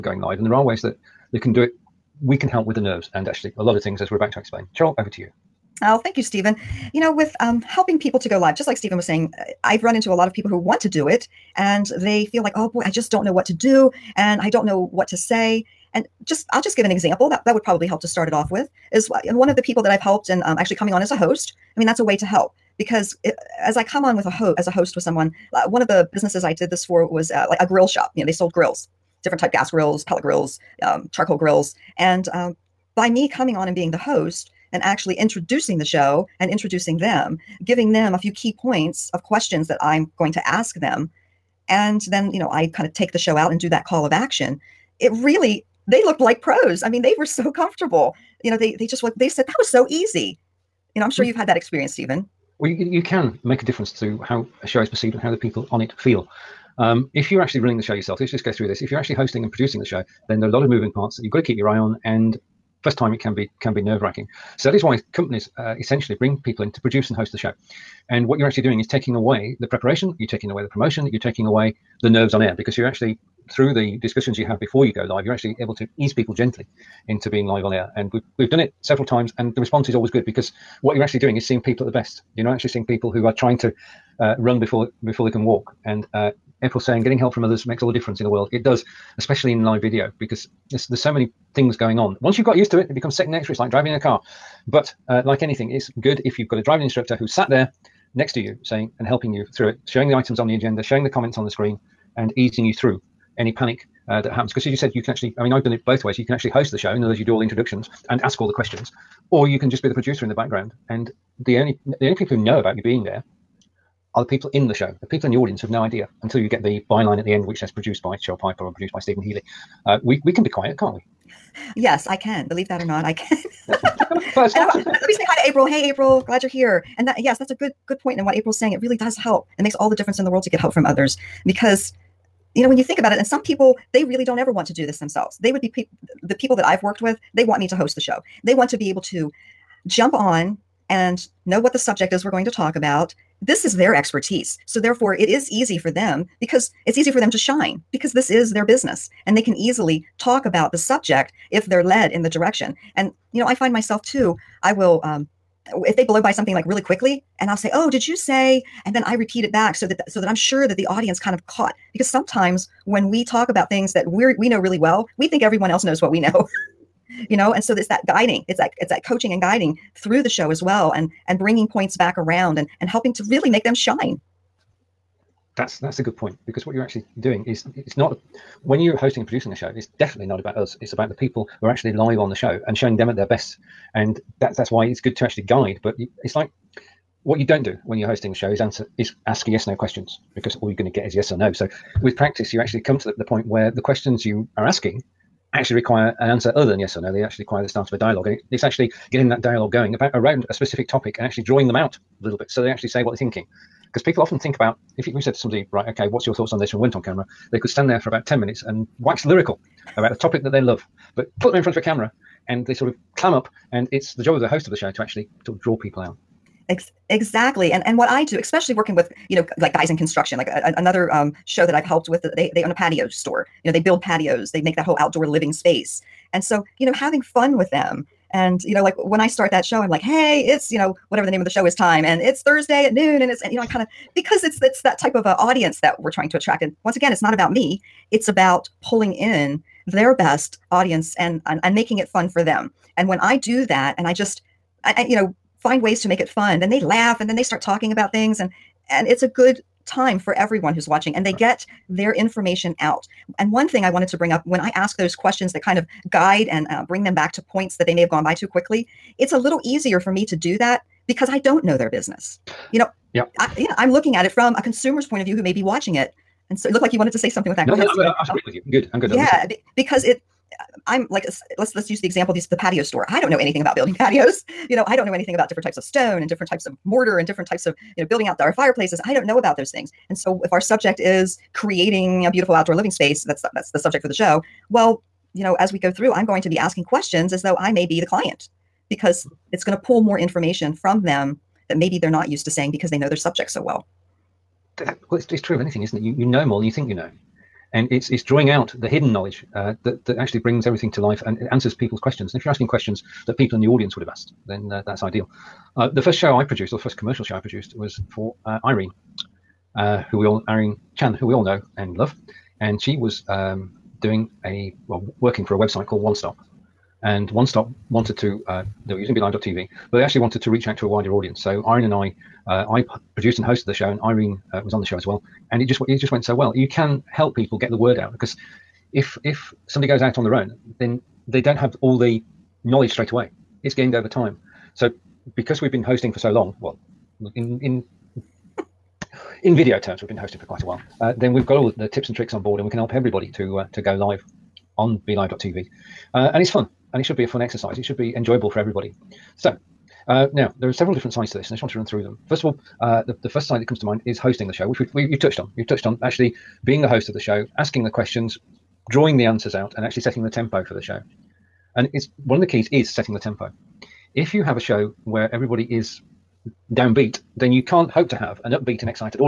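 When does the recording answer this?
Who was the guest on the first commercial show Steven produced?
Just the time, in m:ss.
5:10.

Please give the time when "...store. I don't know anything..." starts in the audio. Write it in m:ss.
4:32.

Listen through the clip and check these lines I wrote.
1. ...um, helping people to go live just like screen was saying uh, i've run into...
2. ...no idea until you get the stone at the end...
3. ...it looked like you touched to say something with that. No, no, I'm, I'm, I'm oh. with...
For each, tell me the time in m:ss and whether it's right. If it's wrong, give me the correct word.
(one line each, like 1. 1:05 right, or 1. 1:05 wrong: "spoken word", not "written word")
1. 0:07 wrong: "steven", not "screen"
2. 1:55 wrong: "byline", not "stone"
3. 4:26 wrong: "wanted", not "touched".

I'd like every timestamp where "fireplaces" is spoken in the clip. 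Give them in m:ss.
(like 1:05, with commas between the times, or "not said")
4:38.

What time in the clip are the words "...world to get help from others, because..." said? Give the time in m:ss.
2:10.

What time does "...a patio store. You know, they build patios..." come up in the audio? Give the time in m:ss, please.
3:42.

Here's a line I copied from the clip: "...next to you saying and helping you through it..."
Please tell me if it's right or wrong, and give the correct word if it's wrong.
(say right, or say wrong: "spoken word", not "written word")
right.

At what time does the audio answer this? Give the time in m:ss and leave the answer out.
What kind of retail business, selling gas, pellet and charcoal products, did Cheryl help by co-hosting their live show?
0:27.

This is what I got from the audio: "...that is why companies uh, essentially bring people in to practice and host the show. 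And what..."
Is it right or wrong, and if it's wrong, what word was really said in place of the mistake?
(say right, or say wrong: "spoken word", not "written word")
wrong: "produce", not "practice".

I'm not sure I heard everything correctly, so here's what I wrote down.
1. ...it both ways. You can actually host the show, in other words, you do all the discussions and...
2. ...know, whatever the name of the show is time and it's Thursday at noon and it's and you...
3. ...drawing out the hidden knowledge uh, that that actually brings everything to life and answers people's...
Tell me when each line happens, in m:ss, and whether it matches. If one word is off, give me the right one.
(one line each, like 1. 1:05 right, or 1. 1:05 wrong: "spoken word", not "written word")
1. 1:45 wrong: "introductions", not "discussions"
2. 3:50 right
3. 4:58 right.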